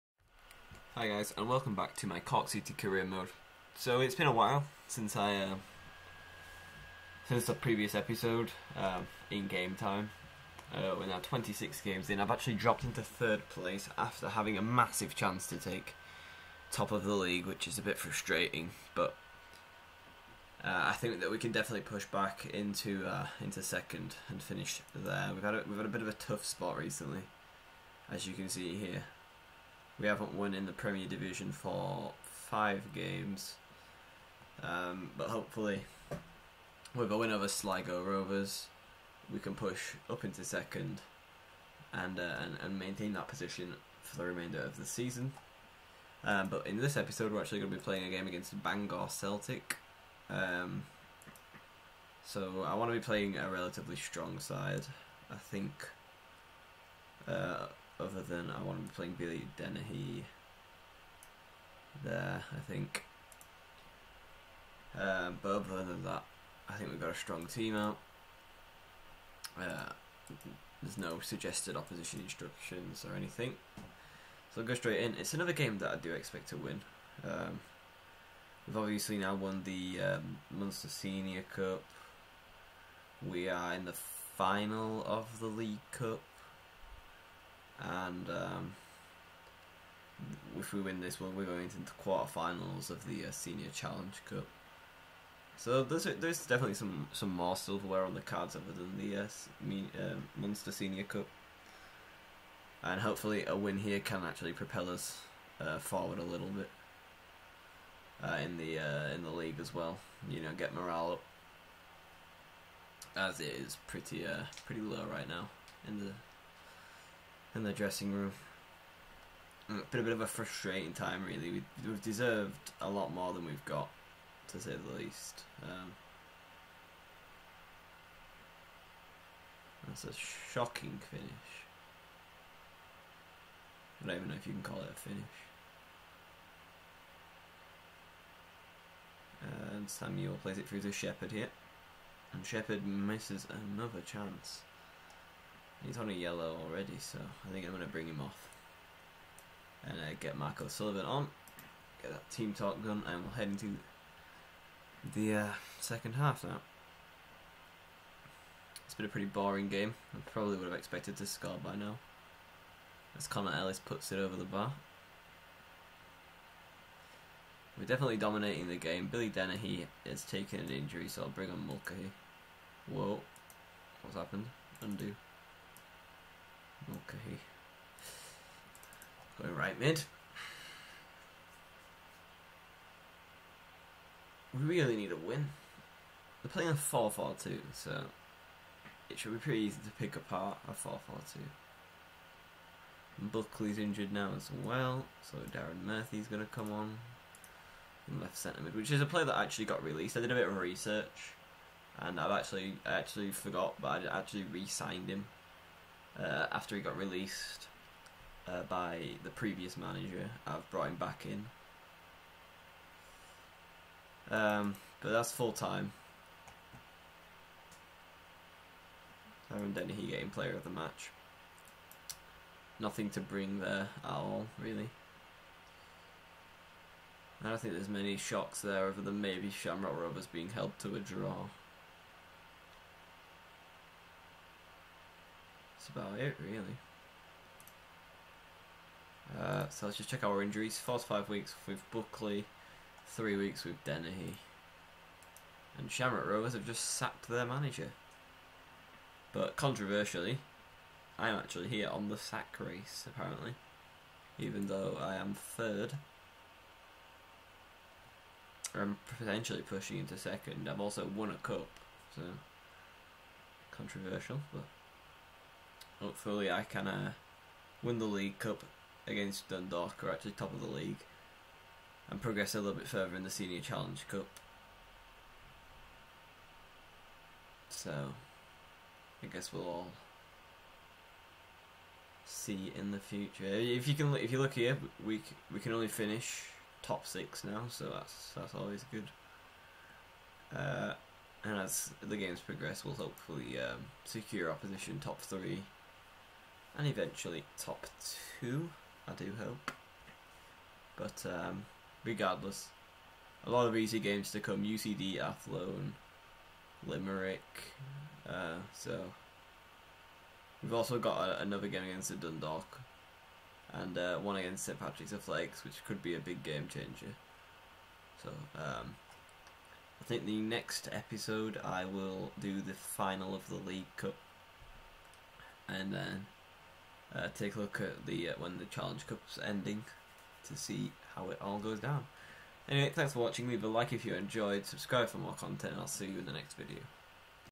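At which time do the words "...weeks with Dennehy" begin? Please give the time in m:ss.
4:03.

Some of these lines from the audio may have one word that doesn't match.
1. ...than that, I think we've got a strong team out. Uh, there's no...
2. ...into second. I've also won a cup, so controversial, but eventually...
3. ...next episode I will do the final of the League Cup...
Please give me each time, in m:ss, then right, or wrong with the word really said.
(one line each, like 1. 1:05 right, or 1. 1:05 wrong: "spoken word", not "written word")
1. 1:05 right
2. 4:19 wrong: "hopefully", not "eventually"
3. 5:20 right.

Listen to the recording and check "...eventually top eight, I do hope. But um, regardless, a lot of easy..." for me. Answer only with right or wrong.
wrong.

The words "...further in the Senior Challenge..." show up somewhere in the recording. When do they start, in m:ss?
4:32.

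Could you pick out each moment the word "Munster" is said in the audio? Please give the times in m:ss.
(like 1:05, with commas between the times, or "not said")
1:20, 1:40.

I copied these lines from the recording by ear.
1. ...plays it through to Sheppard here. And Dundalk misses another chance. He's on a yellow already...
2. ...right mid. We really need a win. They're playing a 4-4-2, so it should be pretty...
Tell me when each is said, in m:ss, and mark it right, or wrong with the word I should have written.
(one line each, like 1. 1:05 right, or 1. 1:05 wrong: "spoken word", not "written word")
1. 2:20 wrong: "Sheppard", not "Dundalk"
2. 2:59 right.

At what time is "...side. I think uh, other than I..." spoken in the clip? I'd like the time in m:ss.
0:54.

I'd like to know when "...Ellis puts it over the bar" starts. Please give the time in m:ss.
2:43.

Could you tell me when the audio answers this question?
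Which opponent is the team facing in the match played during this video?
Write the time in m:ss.
0:48.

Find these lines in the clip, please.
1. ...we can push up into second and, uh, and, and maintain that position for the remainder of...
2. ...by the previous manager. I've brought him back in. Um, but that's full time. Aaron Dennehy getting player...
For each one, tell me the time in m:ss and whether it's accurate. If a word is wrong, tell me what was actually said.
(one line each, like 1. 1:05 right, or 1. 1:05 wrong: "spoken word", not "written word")
1. 0:39 right
2. 3:28 right.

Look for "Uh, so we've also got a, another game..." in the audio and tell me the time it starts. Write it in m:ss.
5:08.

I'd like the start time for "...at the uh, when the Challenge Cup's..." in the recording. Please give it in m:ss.
5:27.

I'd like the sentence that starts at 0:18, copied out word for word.
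But uh, I think that we can definitely push back into uh, into second and finish there.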